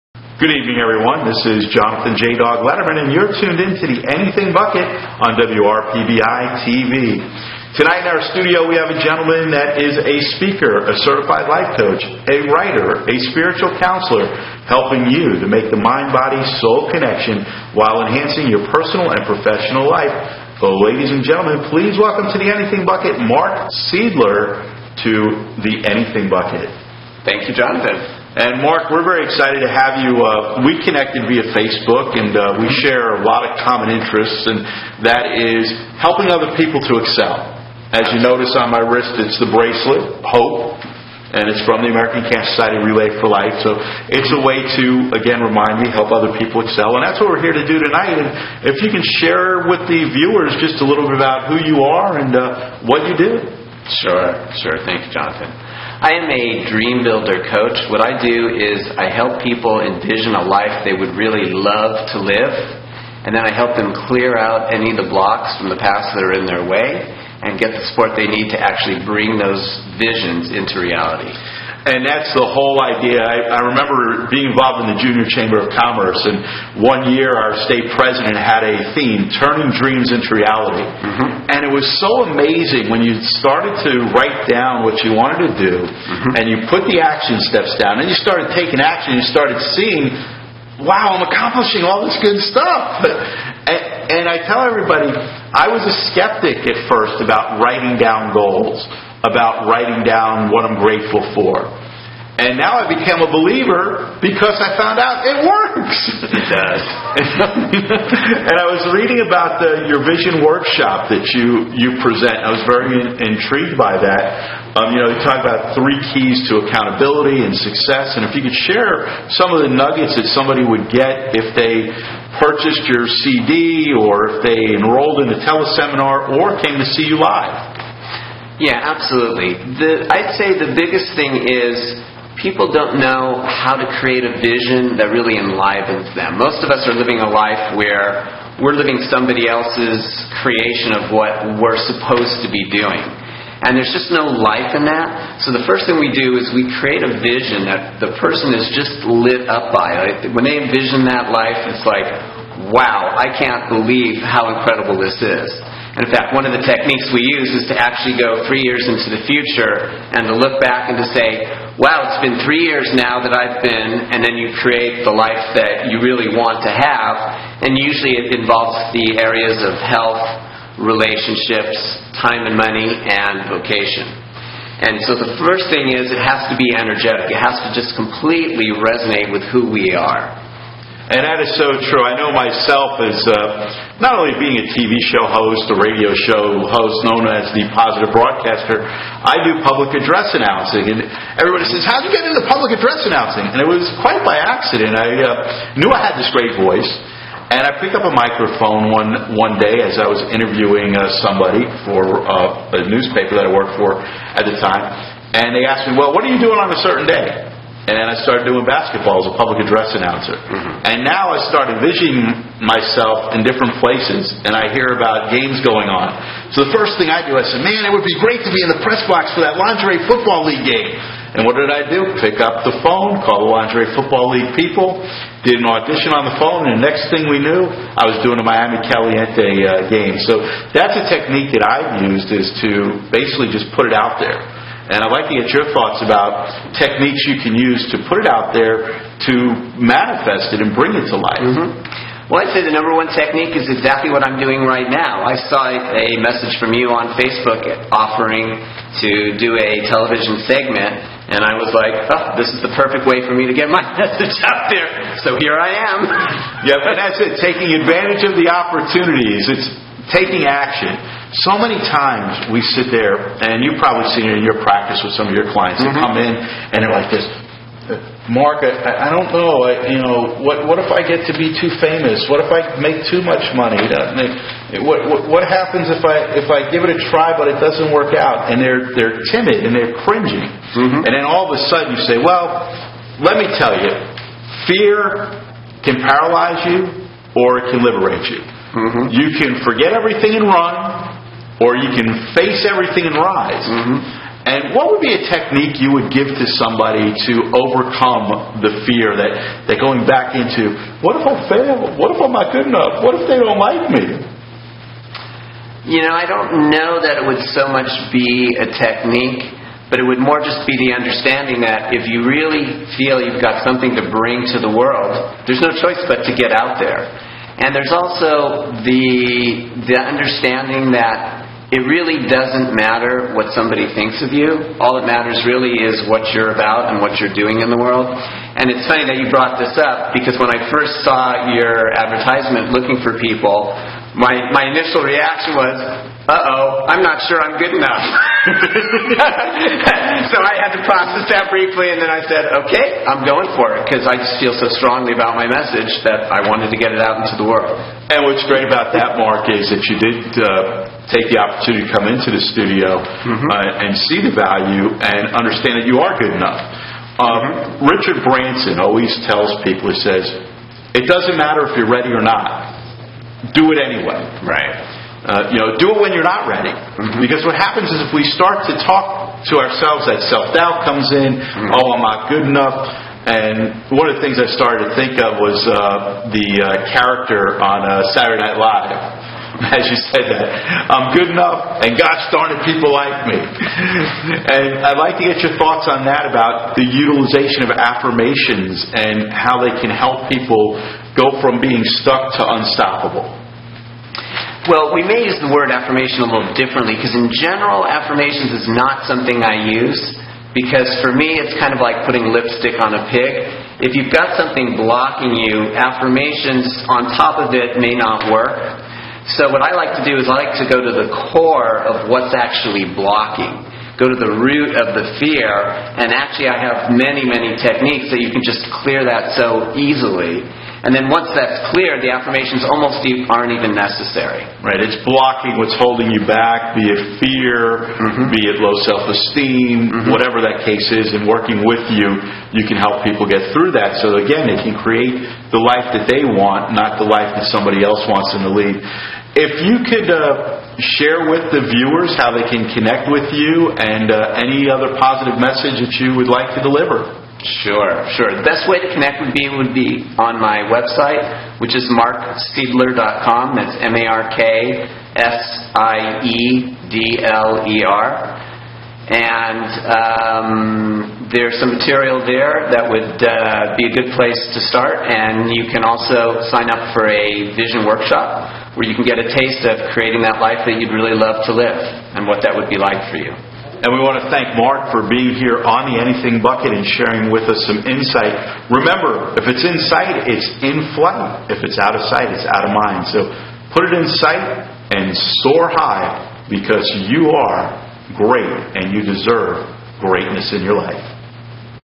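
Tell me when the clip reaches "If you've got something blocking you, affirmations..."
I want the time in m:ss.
6:43.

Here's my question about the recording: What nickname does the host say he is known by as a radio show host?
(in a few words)
the positive broadcaster.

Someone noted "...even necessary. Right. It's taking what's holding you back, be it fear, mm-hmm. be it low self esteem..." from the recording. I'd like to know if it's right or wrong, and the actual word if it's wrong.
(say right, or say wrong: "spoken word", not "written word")
wrong: "blocking", not "taking".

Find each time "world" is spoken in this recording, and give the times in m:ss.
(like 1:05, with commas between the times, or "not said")
5:14, 5:27, 5:47.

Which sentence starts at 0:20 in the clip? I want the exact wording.
So, ladies and gentlemen, please welcome to the Anything Bucket Mark Siedler, to the Anything Bucket.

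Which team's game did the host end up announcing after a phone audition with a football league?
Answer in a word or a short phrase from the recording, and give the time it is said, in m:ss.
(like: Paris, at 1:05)
Miami Caliente, at 3:48.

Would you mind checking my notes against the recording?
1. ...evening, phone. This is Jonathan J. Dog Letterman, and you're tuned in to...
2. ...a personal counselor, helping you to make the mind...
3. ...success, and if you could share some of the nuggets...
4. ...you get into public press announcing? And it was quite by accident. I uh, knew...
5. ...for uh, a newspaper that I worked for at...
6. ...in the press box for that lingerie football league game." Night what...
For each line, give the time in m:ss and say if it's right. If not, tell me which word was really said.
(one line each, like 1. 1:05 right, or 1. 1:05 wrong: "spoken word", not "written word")
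1. 0:00 wrong: "everyone", not "phone"
2. 0:13 wrong: "spiritual", not "personal"
3. 1:57 right
4. 3:12 wrong: "address", not "press"
5. 3:21 right
6. 3:38 wrong: "And", not "Night".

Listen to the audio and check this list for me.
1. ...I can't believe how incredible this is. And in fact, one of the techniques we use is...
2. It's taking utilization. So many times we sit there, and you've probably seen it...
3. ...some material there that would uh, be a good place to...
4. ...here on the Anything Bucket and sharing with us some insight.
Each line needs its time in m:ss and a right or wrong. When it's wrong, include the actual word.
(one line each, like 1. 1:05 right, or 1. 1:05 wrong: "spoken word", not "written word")
1. 2:33 right
2. 4:19 wrong: "action", not "utilization"
3. 7:41 right
4. 7:55 right.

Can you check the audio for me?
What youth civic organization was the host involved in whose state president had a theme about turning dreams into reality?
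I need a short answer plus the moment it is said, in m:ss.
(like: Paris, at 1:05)
Junior Chamber of Commerce, at 1:15.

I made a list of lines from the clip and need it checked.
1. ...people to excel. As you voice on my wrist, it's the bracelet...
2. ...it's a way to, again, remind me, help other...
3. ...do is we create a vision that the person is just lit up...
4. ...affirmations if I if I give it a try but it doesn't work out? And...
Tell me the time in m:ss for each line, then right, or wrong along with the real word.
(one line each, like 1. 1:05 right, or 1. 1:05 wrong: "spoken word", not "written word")
1. 0:36 wrong: "notice", not "voice"
2. 0:44 right
3. 2:26 right
4. 4:35 wrong: "happens", not "affirmations".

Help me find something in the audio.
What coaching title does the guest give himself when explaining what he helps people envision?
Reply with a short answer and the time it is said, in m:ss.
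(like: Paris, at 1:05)
dream builder coach, at 0:56.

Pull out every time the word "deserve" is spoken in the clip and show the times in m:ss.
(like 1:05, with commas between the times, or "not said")
8:09.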